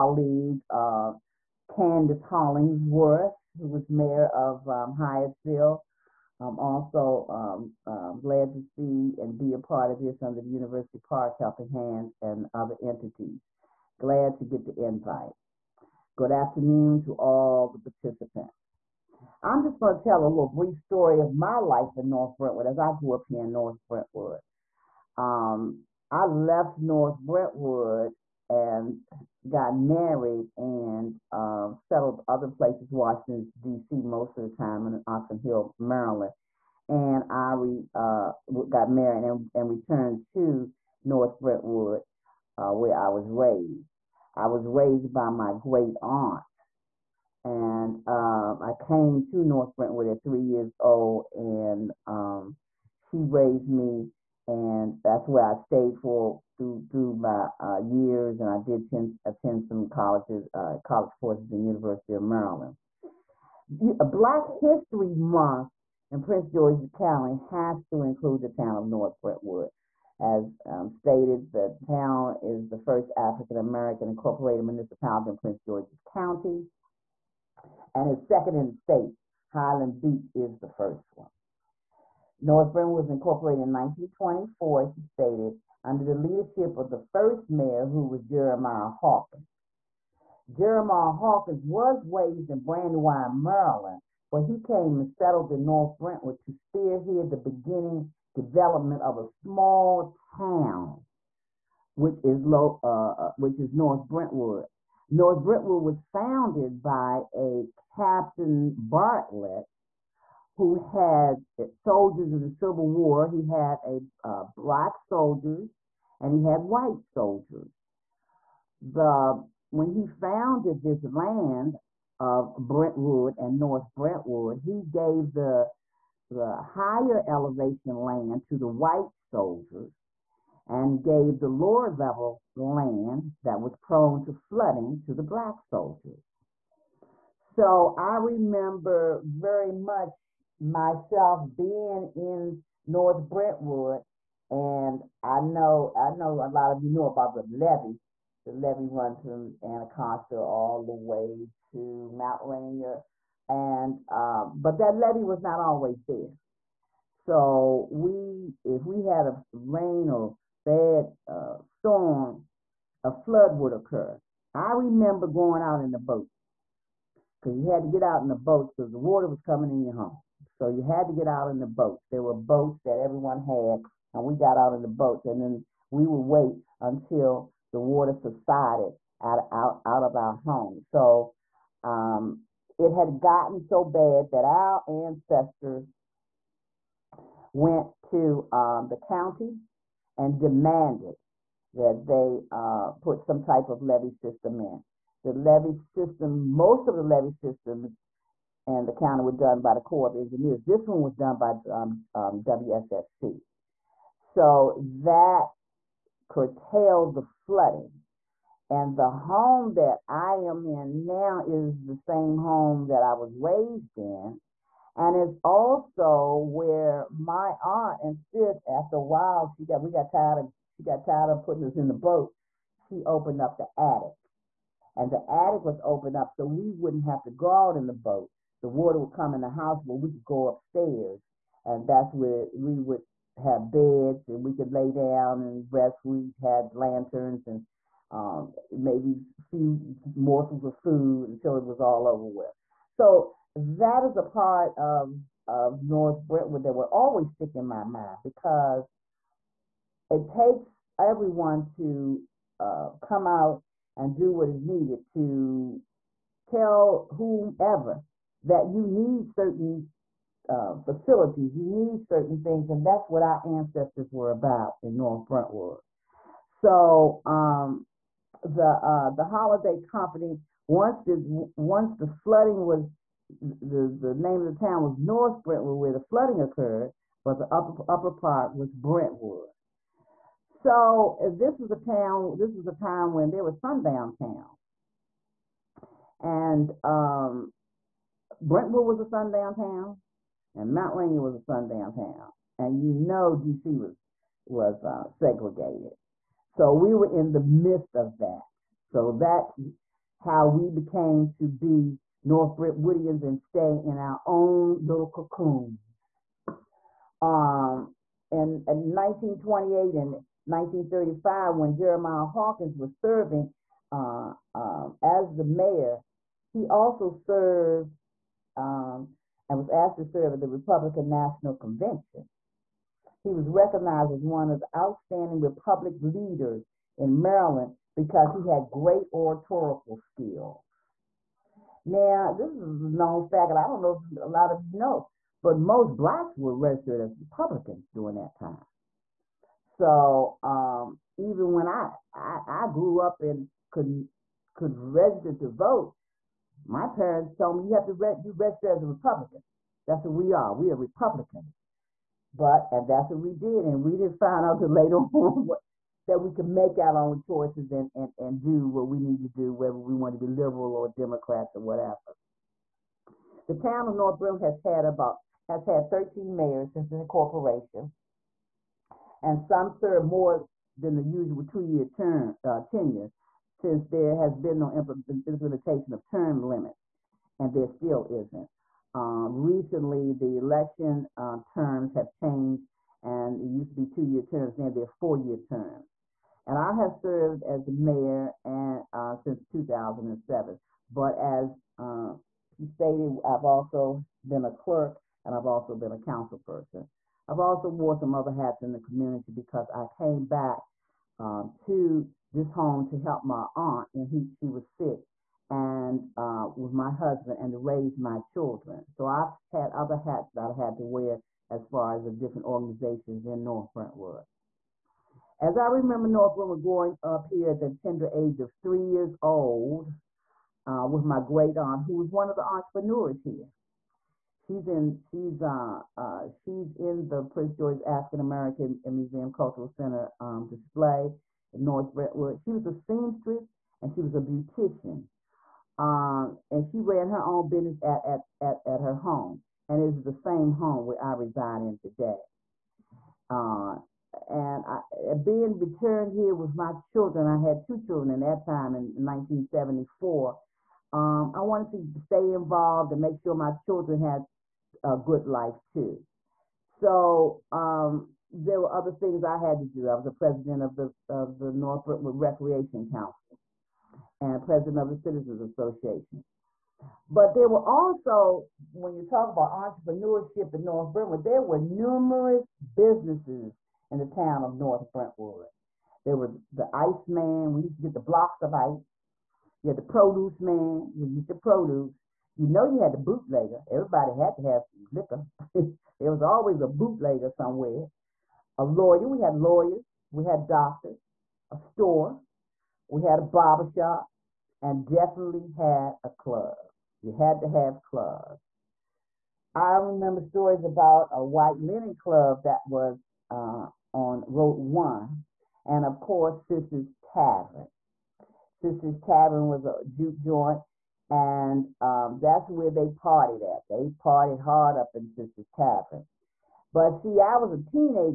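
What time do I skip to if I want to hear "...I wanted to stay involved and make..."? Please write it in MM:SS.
07:31.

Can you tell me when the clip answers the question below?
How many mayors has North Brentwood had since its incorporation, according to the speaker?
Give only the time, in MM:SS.
06:05.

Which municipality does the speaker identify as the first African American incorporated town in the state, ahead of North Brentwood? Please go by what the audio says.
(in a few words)
Highland Beach.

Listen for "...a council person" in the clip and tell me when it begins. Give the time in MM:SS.
06:35.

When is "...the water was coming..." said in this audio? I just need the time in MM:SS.
02:48.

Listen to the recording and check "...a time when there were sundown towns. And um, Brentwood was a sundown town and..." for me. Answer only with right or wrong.
right.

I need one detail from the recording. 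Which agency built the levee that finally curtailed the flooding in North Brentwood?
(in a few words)
WSSC.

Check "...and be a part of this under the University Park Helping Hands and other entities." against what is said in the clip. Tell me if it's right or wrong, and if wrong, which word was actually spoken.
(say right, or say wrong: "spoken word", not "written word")
right.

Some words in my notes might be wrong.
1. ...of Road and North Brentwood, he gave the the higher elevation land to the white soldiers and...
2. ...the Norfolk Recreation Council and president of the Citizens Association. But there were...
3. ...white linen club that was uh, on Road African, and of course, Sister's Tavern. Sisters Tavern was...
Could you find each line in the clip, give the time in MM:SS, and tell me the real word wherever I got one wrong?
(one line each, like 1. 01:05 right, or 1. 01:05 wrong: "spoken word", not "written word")
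1. 02:02 wrong: "Brentwood", not "Road"
2. 07:41 right
3. 08:21 wrong: "One", not "African".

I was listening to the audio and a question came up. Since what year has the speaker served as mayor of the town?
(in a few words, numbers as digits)
2007.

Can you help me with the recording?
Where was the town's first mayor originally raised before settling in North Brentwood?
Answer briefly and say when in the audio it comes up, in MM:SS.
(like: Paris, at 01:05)
Brandywine, Maryland, at 01:32.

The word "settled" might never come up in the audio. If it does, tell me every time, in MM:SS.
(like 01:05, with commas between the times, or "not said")
00:31, 01:35.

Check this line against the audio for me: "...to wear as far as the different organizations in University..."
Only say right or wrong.
wrong.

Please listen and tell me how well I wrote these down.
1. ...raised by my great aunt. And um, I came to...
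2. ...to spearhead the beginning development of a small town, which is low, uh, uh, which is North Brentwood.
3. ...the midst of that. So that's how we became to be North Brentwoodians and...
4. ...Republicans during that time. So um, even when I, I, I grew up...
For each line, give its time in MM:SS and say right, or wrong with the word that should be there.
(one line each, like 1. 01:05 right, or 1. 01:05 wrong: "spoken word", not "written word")
1. 00:44 right
2. 01:36 right
3. 04:57 right
4. 05:37 right.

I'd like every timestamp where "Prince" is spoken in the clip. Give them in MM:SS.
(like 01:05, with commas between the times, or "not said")
01:06, 01:15, 07:07.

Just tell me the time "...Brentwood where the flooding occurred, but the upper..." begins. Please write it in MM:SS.
04:35.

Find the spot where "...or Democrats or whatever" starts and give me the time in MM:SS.
06:00.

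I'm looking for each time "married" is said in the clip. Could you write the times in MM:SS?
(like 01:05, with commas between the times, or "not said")
00:29, 00:38.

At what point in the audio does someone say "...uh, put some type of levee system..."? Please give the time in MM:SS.
03:12.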